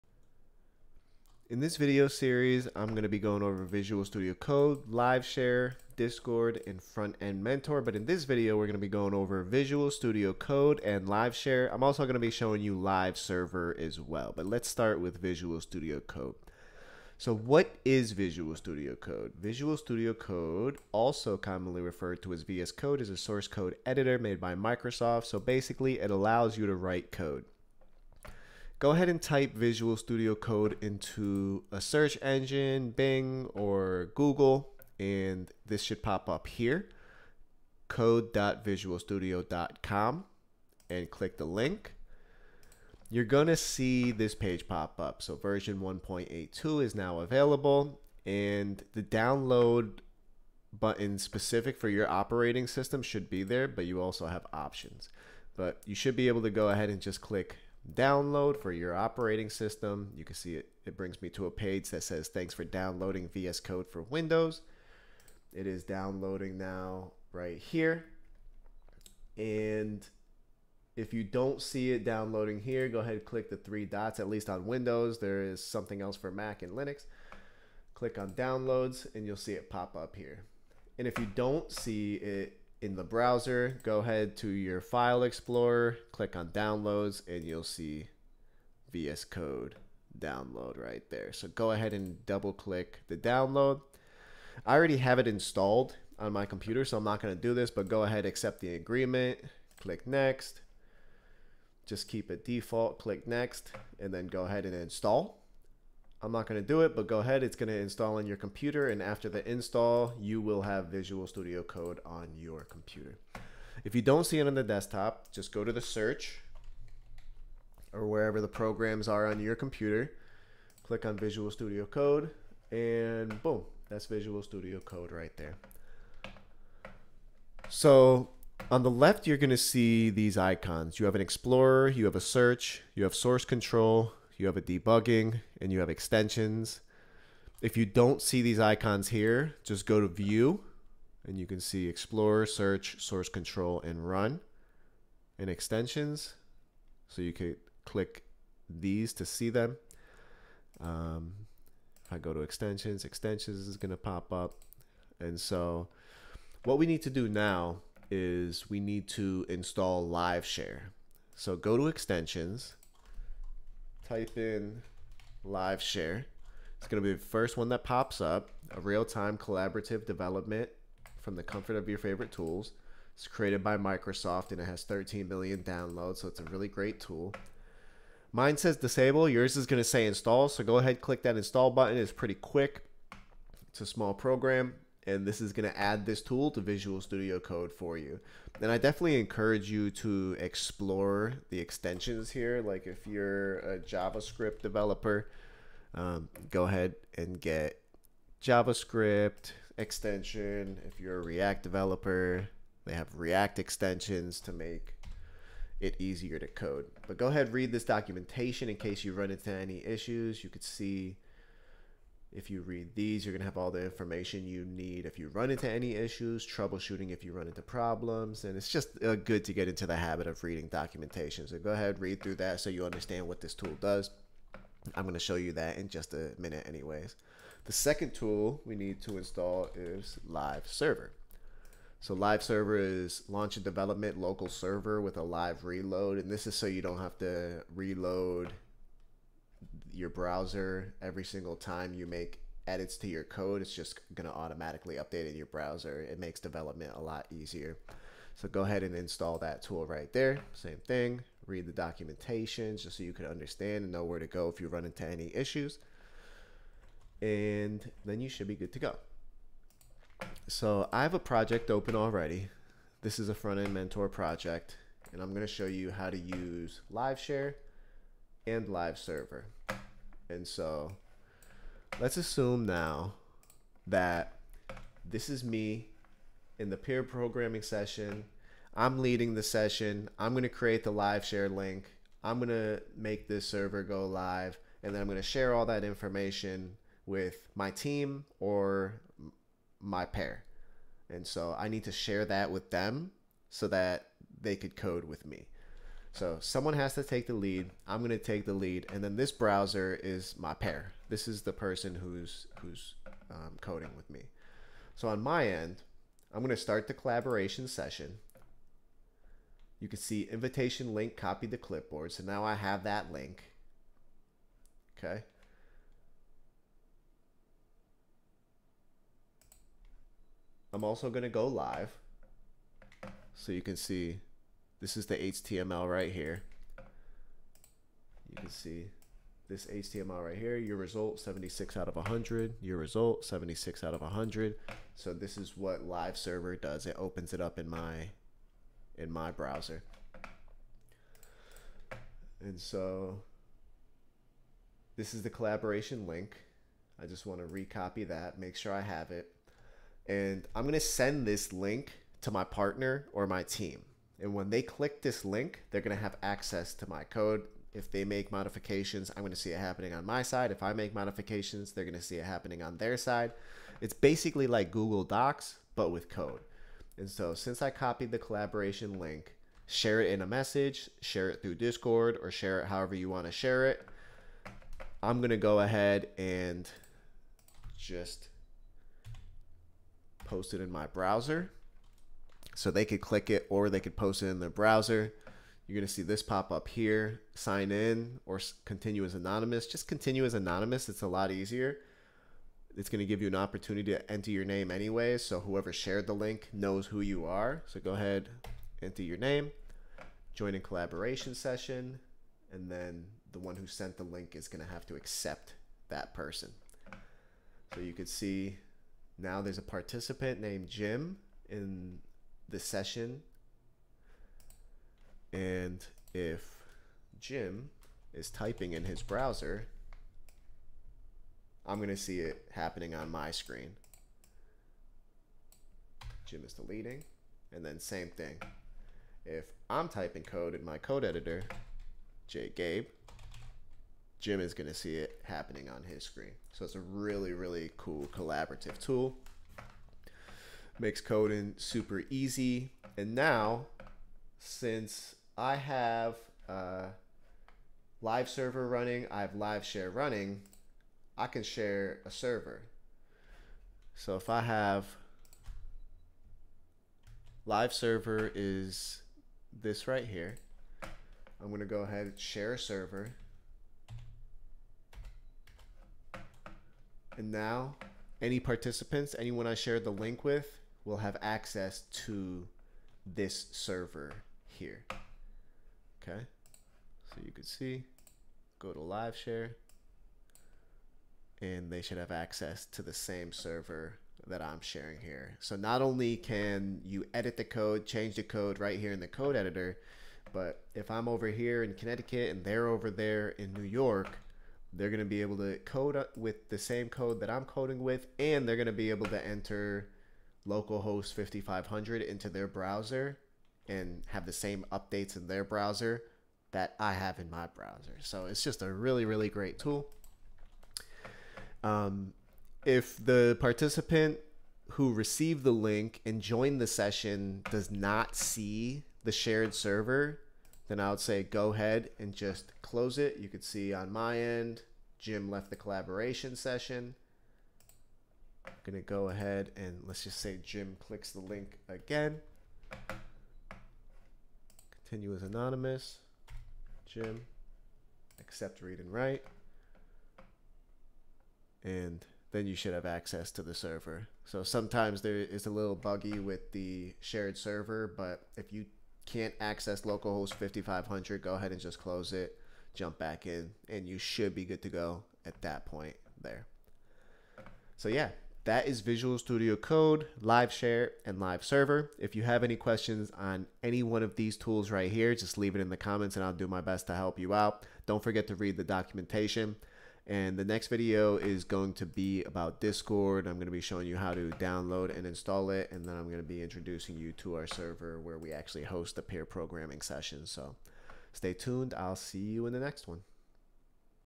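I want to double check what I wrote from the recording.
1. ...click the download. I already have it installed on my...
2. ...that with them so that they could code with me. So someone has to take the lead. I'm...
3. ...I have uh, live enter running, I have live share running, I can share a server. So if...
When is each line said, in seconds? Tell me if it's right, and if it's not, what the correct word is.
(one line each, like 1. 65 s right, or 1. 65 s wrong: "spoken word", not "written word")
1. 92 s right
2. 292 s right
3. 445 s wrong: "server", not "enter".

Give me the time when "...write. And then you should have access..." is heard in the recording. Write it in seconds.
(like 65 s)
538 s.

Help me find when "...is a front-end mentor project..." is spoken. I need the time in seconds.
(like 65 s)
263 s.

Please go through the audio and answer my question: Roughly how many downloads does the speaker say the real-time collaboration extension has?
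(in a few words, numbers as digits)
13 million.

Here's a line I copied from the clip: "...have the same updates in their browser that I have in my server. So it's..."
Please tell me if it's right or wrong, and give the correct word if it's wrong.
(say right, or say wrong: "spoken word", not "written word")
wrong: "browser", not "server".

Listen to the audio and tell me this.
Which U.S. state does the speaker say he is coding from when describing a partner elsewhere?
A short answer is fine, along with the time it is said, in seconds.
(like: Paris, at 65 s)
Connecticut, at 491 s.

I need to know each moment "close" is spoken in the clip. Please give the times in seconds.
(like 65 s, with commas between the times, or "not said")
522 s, 551 s.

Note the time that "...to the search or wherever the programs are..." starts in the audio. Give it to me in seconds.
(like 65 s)
115 s.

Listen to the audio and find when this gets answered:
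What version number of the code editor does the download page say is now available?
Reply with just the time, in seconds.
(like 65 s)
45 s.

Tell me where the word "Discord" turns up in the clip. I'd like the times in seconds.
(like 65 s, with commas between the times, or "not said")
5 s, 371 s, 572 s.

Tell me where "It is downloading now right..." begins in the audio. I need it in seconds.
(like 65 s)
65 s.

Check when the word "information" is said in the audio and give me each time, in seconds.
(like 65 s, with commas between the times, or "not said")
213 s, 285 s.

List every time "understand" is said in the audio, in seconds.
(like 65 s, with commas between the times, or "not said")
222 s, 253 s.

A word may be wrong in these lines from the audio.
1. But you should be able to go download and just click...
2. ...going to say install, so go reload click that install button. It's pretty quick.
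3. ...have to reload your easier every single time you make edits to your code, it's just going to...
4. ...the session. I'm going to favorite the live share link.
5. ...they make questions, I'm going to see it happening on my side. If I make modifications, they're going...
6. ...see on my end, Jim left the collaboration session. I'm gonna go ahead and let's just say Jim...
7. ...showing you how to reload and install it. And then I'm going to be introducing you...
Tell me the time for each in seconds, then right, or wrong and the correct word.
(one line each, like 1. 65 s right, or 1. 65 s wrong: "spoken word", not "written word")
1. 55 s wrong: "ahead", not "download"
2. 179 s wrong: "ahead", not "reload"
3. 236 s wrong: "browser", not "easier"
4. 279 s wrong: "create", not "favorite"
5. 357 s wrong: "modifications", not "questions"
6. 523 s right
7. 573 s wrong: "download", not "reload".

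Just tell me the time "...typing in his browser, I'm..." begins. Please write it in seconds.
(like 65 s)
418 s.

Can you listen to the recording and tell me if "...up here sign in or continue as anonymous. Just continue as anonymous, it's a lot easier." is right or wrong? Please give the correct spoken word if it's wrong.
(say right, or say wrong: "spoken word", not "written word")
right.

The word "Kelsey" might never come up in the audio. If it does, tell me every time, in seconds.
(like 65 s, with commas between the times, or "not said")
not said.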